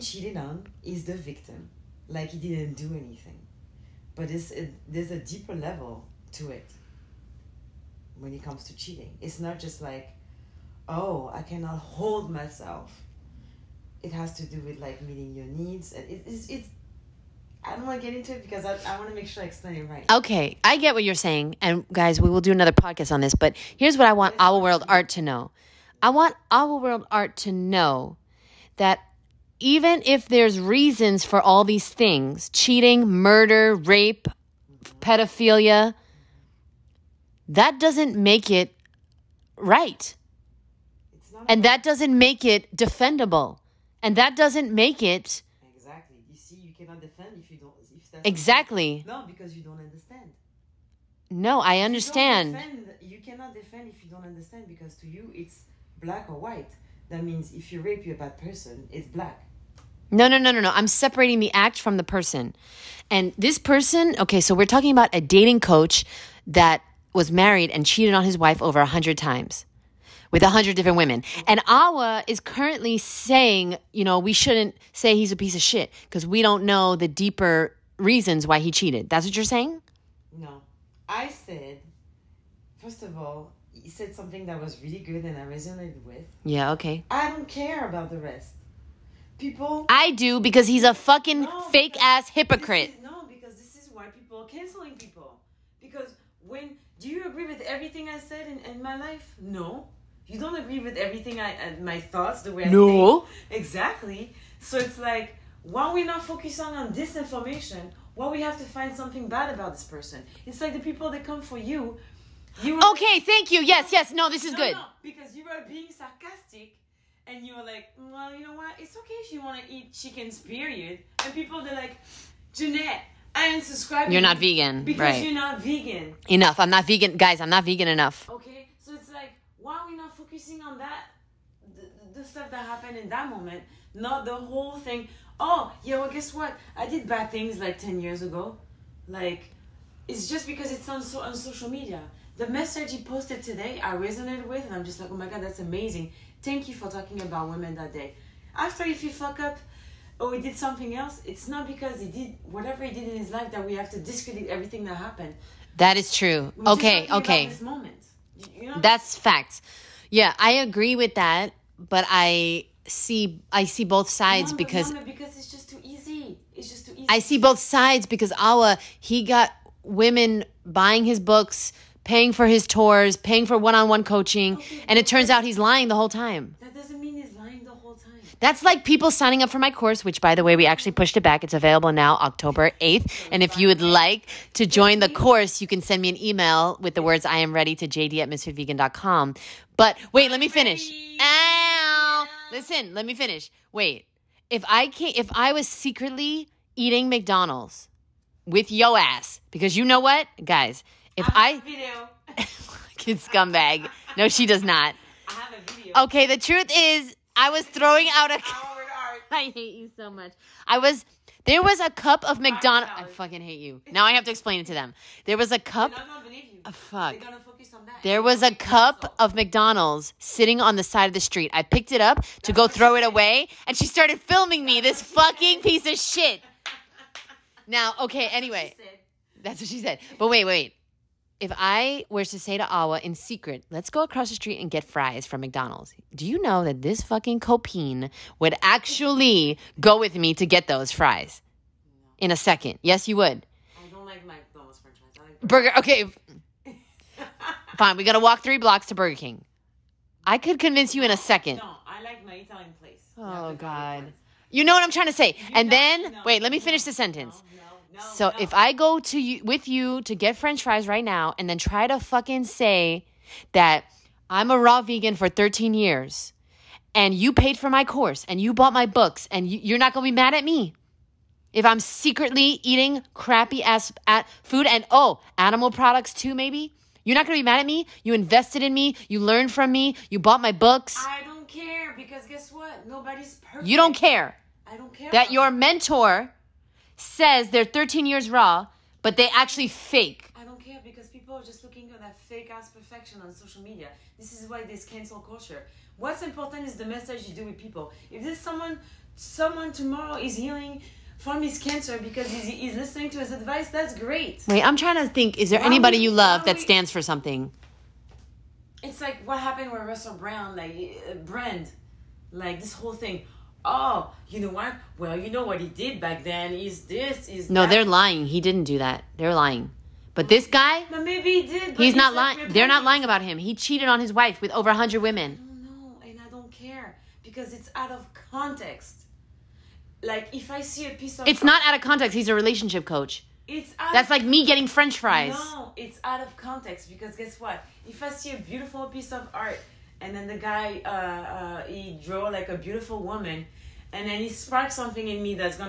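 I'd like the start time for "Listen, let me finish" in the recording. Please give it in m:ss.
3:12.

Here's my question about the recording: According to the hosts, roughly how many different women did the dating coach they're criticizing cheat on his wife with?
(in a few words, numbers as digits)
100.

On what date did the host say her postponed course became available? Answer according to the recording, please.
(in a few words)
October 8th.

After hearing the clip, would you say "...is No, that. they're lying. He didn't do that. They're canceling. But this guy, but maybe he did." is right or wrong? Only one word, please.
wrong.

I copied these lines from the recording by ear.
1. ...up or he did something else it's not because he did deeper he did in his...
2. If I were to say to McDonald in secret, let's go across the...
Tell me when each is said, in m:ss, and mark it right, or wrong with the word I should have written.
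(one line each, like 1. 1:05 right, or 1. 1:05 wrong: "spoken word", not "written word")
1. 2:29 wrong: "whatever", not "deeper"
2. 3:51 wrong: "Awa", not "McDonald".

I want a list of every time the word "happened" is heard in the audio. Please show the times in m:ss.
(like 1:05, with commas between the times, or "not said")
2:12, 2:34, 5:09.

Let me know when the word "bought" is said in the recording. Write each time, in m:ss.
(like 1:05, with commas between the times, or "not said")
4:28, 4:40.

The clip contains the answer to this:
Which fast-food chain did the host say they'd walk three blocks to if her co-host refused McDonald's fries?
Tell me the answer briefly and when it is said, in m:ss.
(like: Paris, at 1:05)
Burger King, at 4:08.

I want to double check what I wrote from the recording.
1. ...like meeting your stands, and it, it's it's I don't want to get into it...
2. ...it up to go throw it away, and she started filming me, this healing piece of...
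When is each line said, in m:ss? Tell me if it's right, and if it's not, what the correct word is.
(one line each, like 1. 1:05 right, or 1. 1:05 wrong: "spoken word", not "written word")
1. 0:14 wrong: "needs", not "stands"
2. 3:41 wrong: "fucking", not "healing".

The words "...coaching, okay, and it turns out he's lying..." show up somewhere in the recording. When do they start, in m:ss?
2:54.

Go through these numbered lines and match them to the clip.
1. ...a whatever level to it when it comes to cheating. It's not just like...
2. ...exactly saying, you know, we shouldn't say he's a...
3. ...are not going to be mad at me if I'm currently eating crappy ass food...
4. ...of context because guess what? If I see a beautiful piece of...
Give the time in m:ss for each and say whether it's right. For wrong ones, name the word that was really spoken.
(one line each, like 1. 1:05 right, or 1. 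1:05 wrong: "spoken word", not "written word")
1. 0:05 wrong: "deeper", not "whatever"
2. 1:12 wrong: "currently", not "exactly"
3. 4:29 wrong: "secretly", not "currently"
4. 5:36 right.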